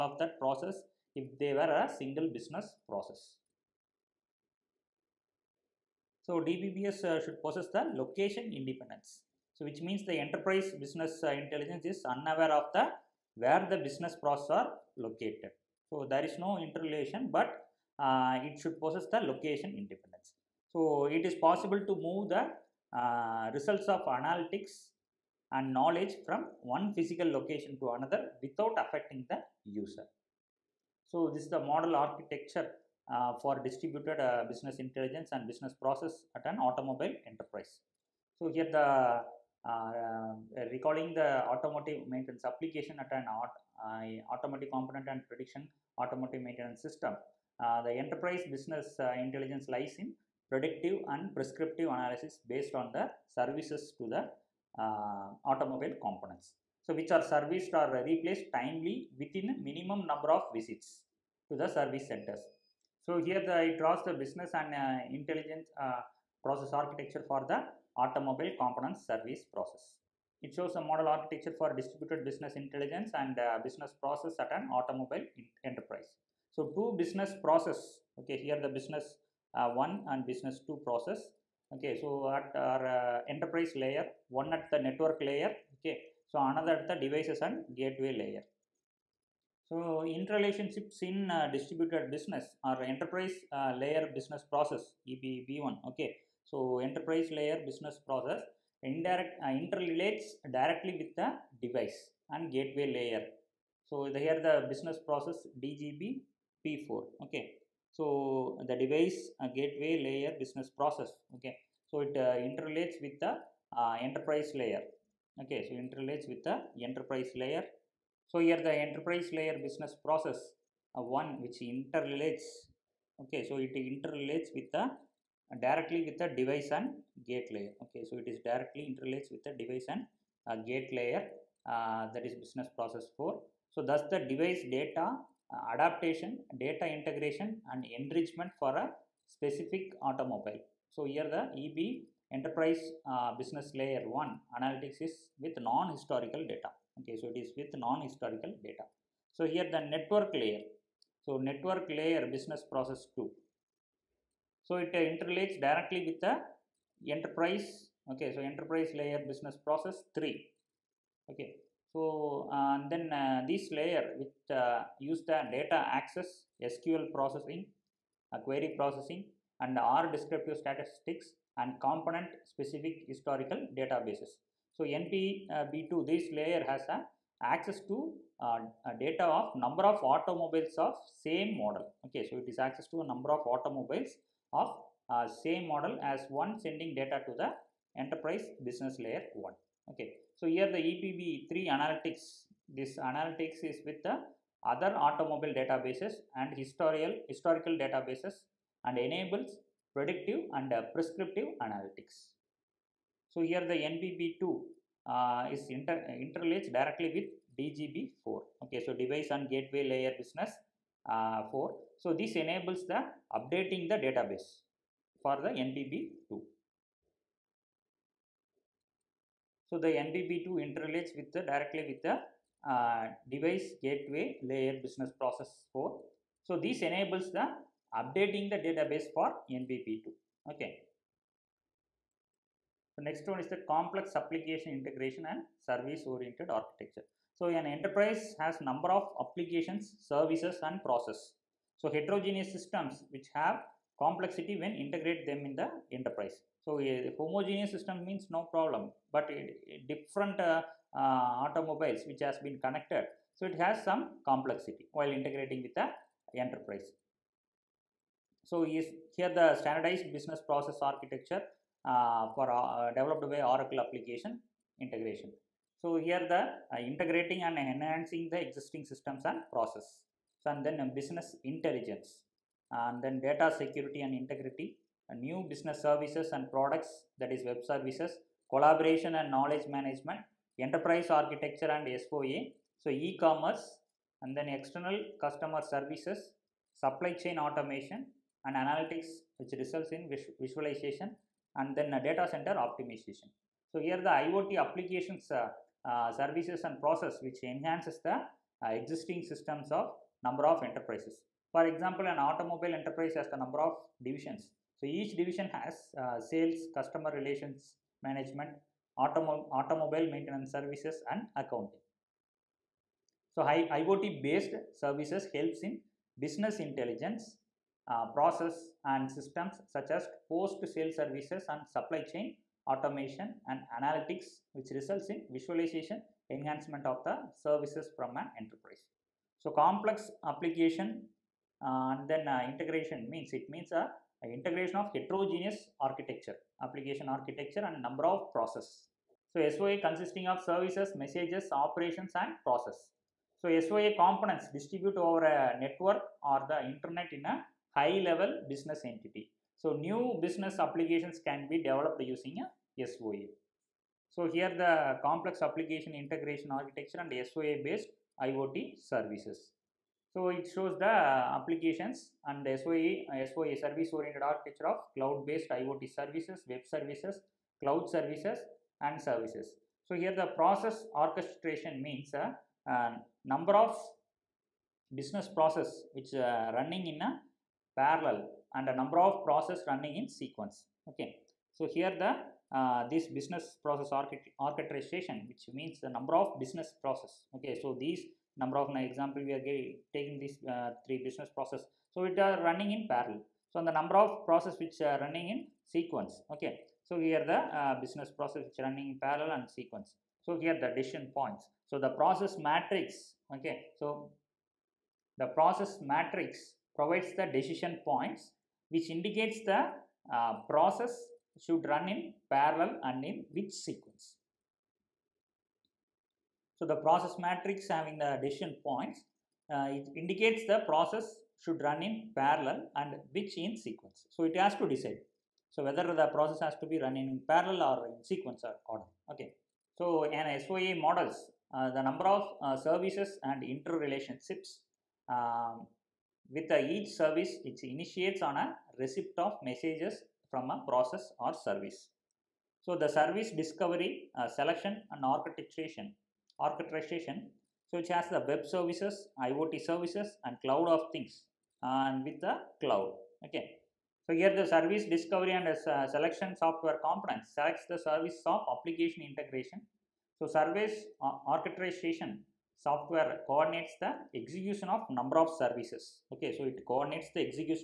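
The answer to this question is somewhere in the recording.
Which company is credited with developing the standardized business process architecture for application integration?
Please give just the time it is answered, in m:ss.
4:23.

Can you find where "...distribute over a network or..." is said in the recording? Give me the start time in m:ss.
5:44.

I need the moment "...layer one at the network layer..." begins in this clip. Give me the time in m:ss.
1:23.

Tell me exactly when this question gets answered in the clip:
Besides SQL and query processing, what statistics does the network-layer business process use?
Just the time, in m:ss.
2:49.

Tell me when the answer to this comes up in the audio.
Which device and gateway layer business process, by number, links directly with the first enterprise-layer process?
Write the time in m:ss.
1:45.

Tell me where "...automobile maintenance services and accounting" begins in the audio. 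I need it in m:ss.
5:09.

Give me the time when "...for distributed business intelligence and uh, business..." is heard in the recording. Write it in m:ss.
1:11.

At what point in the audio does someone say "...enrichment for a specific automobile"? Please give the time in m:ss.
2:17.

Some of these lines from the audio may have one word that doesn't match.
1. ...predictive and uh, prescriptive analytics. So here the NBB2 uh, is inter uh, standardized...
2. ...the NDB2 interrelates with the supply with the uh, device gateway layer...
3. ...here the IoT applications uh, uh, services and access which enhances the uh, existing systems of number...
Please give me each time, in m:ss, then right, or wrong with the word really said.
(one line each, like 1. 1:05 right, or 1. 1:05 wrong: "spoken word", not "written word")
1. 3:19 wrong: "interlaced", not "standardized"
2. 3:39 wrong: "directly", not "supply"
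3. 4:53 wrong: "process", not "access".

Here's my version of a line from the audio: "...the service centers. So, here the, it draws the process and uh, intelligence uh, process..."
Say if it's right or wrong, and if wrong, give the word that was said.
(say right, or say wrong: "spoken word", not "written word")
wrong: "business", not "process".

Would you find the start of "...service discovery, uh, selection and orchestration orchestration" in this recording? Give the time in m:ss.
7:22.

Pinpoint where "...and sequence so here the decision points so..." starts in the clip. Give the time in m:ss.
6:39.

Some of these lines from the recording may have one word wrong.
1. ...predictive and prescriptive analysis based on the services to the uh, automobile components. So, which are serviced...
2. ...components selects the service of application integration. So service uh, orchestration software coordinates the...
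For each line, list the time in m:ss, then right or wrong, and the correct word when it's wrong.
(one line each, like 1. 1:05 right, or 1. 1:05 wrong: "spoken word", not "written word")
1. 0:50 right
2. 7:36 right.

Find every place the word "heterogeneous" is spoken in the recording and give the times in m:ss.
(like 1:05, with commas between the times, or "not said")
4:01, 5:34.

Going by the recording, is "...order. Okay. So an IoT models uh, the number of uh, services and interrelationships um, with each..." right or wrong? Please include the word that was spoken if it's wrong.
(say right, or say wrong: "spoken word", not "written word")
wrong: "SOA", not "IoT".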